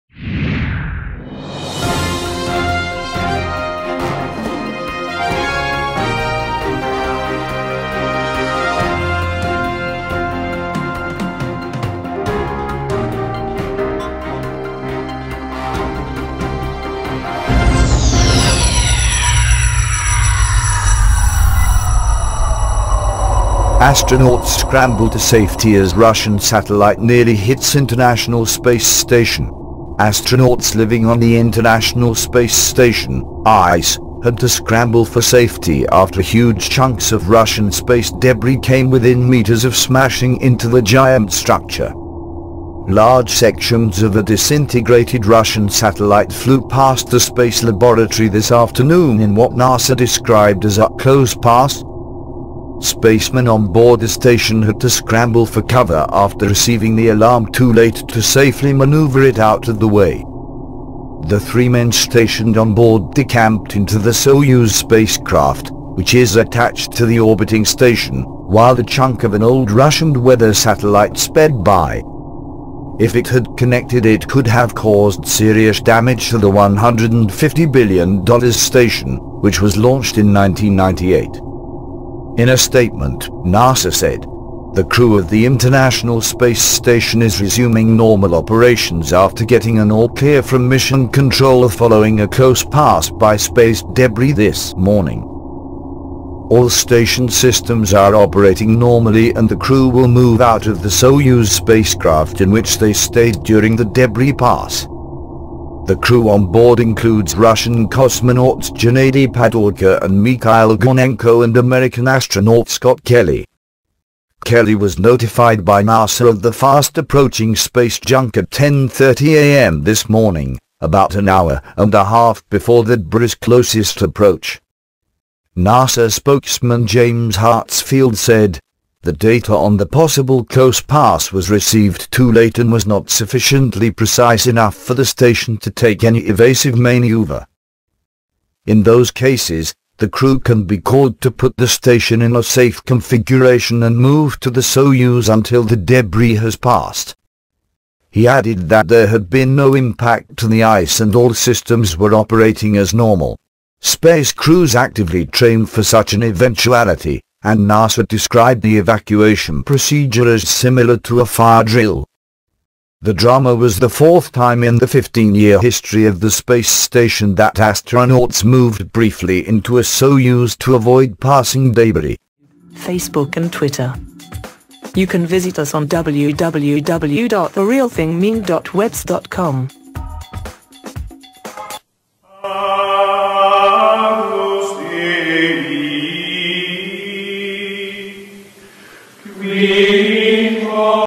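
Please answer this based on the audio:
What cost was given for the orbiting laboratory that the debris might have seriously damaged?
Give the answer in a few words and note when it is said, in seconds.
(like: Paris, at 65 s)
$150 billion, at 76 s.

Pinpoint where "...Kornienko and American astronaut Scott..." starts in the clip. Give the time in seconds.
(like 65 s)
110 s.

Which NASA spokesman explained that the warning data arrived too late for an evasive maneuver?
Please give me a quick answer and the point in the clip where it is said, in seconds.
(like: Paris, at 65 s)
James Hartsfield, at 126 s.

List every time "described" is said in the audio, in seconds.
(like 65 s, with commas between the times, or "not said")
49 s, 158 s.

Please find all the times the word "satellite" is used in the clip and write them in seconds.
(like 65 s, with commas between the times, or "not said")
26 s, 45 s, 70 s.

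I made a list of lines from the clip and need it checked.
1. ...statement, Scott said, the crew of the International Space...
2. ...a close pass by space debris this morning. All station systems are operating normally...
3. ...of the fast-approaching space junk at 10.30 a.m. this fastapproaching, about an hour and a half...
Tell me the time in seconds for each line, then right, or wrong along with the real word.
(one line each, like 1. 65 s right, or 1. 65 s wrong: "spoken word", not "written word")
1. 82 s wrong: "NASA", not "Scott"
2. 92 s right
3. 116 s wrong: "morning", not "fastapproaching".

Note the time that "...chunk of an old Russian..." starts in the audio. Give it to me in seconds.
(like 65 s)
68 s.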